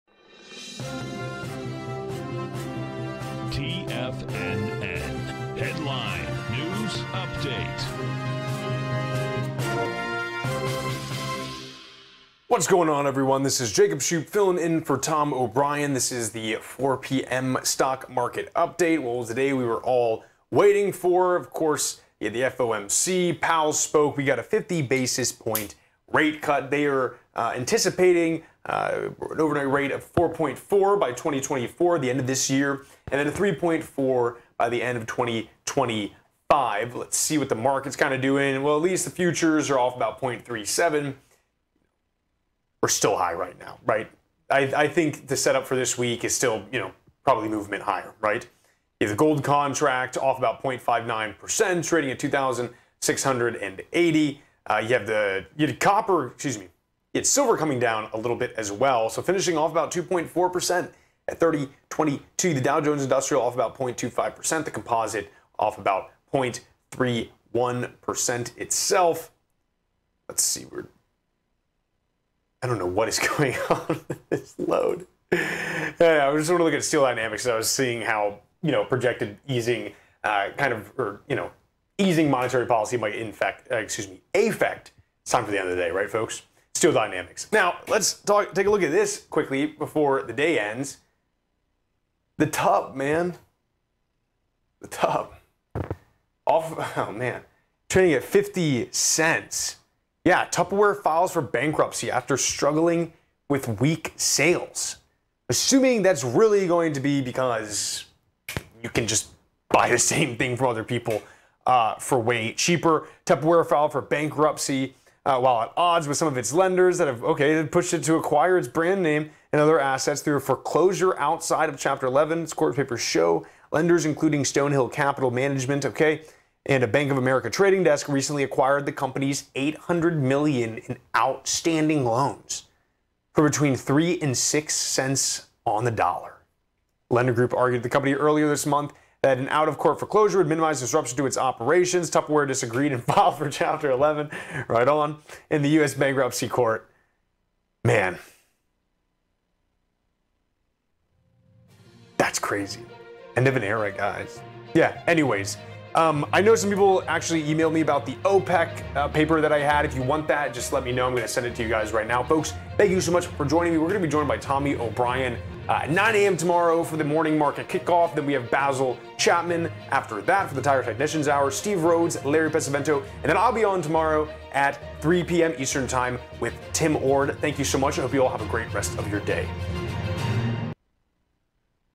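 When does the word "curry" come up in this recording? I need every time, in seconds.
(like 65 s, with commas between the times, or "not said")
not said.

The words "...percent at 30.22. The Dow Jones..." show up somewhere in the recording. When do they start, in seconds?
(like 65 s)
60 s.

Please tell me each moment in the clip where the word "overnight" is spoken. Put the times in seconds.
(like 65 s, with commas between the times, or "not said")
29 s.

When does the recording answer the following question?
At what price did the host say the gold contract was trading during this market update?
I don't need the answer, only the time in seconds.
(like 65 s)
52 s.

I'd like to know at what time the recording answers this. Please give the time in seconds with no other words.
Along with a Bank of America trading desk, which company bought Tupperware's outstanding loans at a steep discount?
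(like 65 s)
124 s.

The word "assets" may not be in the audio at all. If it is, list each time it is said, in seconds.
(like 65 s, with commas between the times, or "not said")
119 s.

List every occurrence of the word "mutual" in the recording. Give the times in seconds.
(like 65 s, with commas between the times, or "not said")
not said.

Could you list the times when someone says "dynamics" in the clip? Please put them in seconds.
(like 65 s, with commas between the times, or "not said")
77 s, 86 s.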